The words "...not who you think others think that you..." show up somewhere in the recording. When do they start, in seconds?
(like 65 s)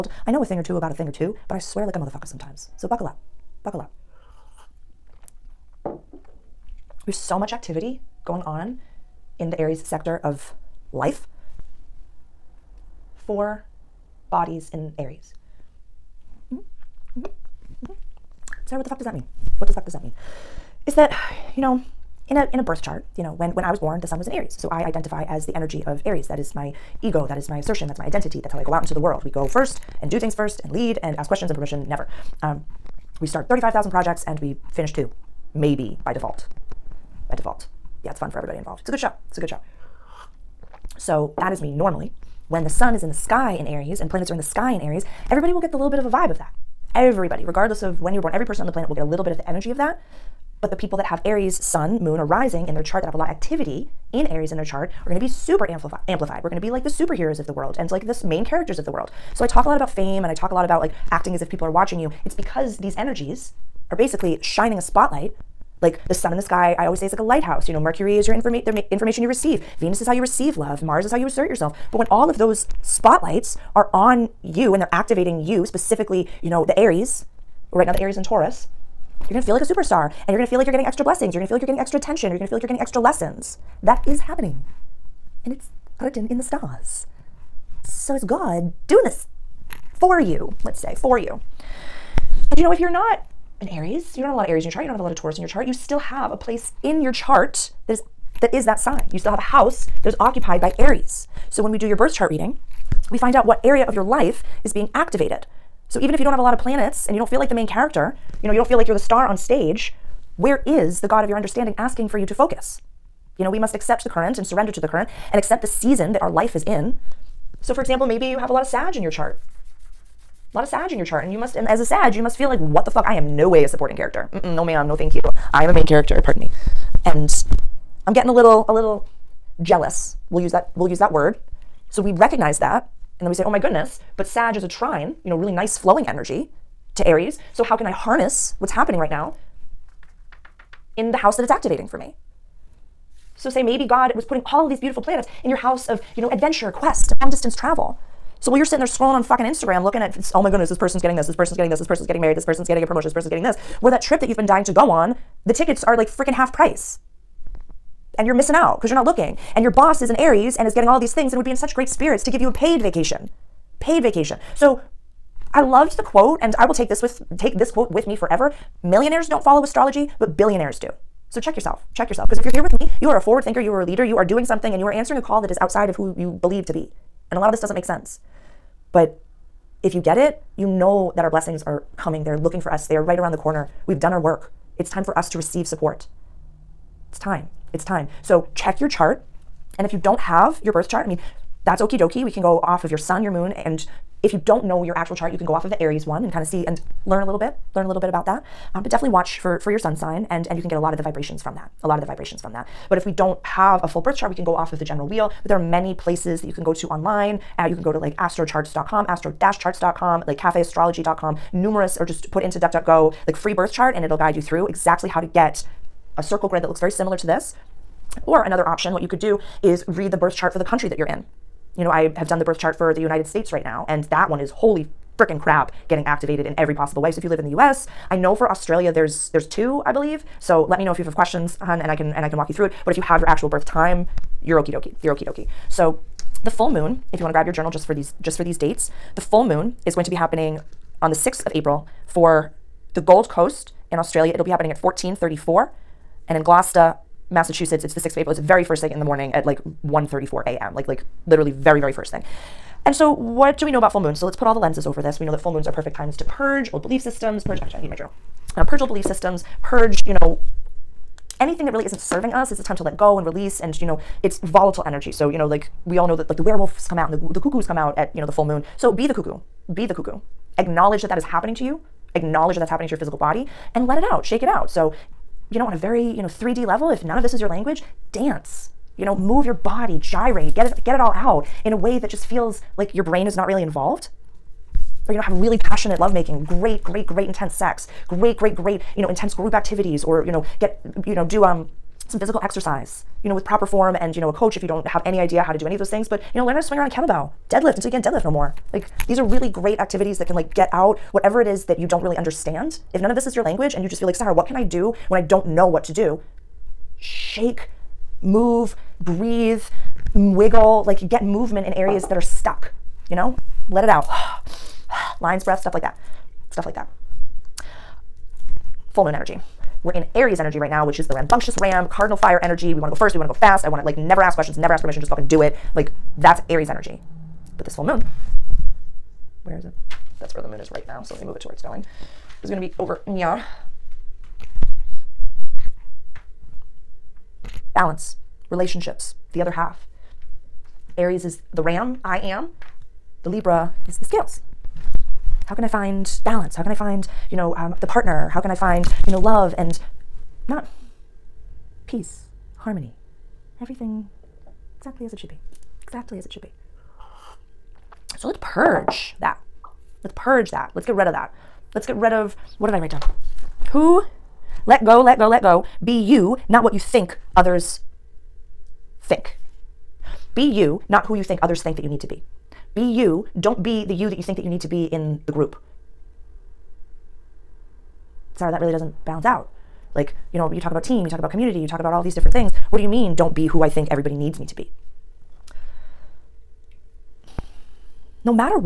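370 s.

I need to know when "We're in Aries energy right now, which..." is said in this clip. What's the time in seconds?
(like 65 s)
319 s.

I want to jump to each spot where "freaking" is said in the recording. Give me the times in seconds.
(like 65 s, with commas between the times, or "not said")
156 s, 225 s.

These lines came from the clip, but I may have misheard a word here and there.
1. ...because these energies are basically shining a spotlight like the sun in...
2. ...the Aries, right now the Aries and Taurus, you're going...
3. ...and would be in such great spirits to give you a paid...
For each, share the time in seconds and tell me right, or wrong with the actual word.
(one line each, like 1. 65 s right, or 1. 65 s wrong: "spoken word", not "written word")
1. 62 s right
2. 76 s right
3. 161 s right.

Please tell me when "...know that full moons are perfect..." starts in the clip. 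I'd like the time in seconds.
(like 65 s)
255 s.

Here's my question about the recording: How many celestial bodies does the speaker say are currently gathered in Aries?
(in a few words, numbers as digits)
4.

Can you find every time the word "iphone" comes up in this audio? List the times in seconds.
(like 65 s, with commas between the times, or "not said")
not said.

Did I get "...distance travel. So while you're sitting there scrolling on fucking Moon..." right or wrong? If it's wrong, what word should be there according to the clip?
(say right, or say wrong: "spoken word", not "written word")
wrong: "Instagram", not "Moon".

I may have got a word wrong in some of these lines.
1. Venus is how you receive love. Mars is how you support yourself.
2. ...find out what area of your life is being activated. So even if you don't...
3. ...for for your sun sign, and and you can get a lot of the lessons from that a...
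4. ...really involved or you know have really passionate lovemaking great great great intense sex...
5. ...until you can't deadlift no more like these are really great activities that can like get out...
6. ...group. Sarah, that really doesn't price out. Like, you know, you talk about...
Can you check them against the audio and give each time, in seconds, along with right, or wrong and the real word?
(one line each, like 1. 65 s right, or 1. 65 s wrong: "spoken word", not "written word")
1. 69 s wrong: "assert", not "support"
2. 103 s right
3. 199 s wrong: "vibrations", not "lessons"
4. 283 s right
5. 297 s right
6. 375 s wrong: "balance", not "price".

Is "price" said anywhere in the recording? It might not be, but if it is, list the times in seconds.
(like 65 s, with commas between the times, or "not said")
156 s.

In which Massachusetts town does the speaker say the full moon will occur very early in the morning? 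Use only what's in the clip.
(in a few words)
Gloucester.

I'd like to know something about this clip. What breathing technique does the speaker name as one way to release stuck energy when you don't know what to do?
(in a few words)
Lion's breath.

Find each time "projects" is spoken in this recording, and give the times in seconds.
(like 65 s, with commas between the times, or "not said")
33 s.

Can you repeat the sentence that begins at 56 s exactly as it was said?
We're going to be like the superheroes of the world and like the main characters of the world.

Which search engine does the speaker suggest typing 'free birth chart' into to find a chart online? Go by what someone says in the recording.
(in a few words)
DuckDuckGo.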